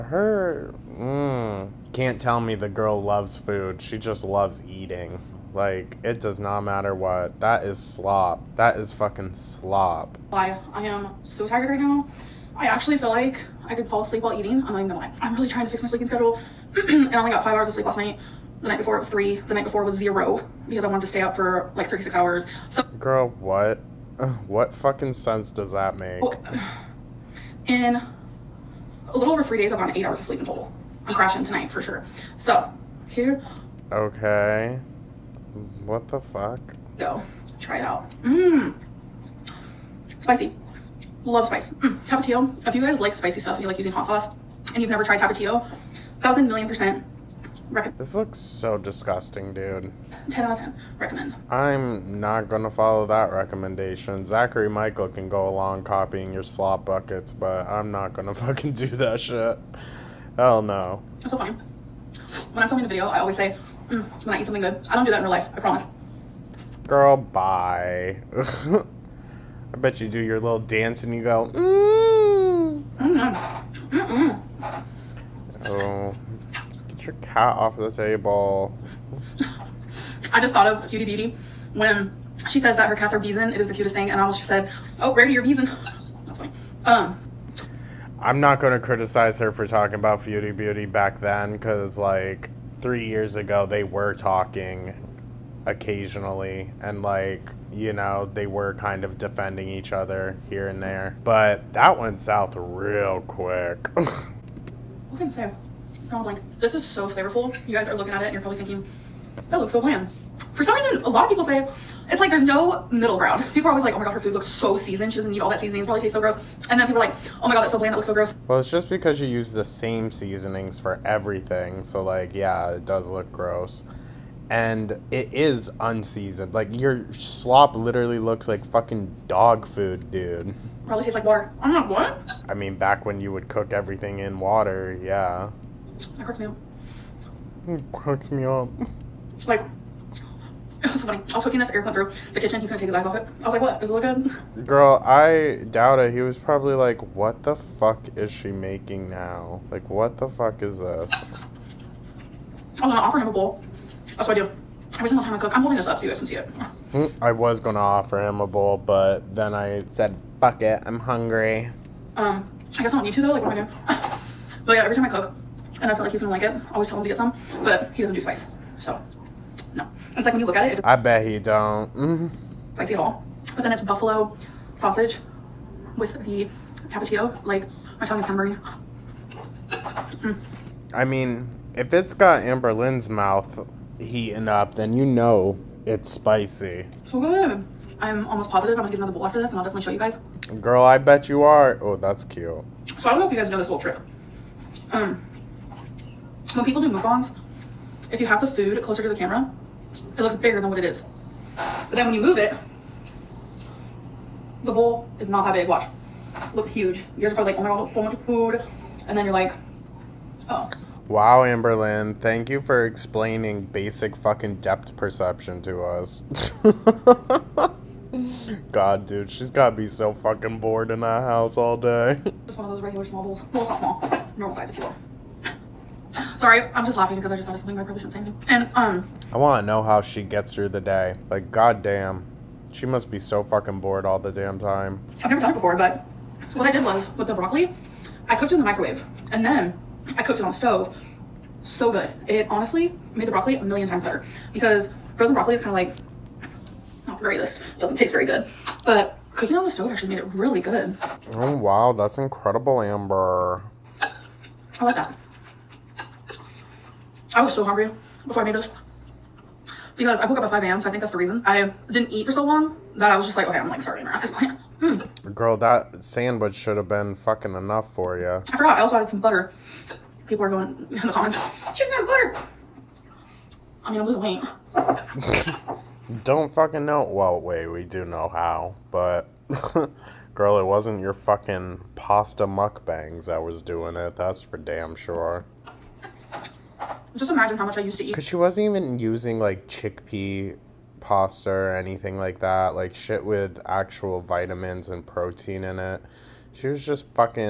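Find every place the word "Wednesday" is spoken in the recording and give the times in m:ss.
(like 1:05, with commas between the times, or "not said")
not said.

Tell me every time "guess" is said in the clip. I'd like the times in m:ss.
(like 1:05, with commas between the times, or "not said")
2:42.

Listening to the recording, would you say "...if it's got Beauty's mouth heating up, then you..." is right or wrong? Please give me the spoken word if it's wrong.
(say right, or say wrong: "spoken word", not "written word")
wrong: "Amberlynn", not "Beauty".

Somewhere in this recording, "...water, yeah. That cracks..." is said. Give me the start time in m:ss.
2:14.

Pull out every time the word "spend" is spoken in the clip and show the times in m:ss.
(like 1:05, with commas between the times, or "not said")
not said.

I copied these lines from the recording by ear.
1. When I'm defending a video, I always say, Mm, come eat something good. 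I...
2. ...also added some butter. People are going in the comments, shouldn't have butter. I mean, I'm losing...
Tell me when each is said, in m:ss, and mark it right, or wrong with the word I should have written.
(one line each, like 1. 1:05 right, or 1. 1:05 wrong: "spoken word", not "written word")
1. 1:02 wrong: "filming", not "defending"
2. 4:28 right.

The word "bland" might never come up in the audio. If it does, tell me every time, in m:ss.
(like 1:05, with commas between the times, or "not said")
1:49, 1:57.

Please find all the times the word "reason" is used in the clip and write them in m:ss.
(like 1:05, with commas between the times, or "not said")
1:50, 4:21.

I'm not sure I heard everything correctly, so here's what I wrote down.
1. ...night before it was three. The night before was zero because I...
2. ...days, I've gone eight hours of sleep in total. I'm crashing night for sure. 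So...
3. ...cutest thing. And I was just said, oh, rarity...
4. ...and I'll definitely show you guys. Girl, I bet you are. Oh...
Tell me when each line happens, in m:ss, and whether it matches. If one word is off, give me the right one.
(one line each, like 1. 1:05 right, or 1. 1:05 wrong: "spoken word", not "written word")
1. 0:18 right
2. 0:29 wrong: "tonight", not "night"
3. 1:23 right
4. 3:09 right.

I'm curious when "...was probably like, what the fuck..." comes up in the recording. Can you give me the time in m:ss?
2:26.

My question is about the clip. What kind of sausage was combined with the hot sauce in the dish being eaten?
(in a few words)
Buffalo sausage.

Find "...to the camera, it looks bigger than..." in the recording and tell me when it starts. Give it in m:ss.
3:19.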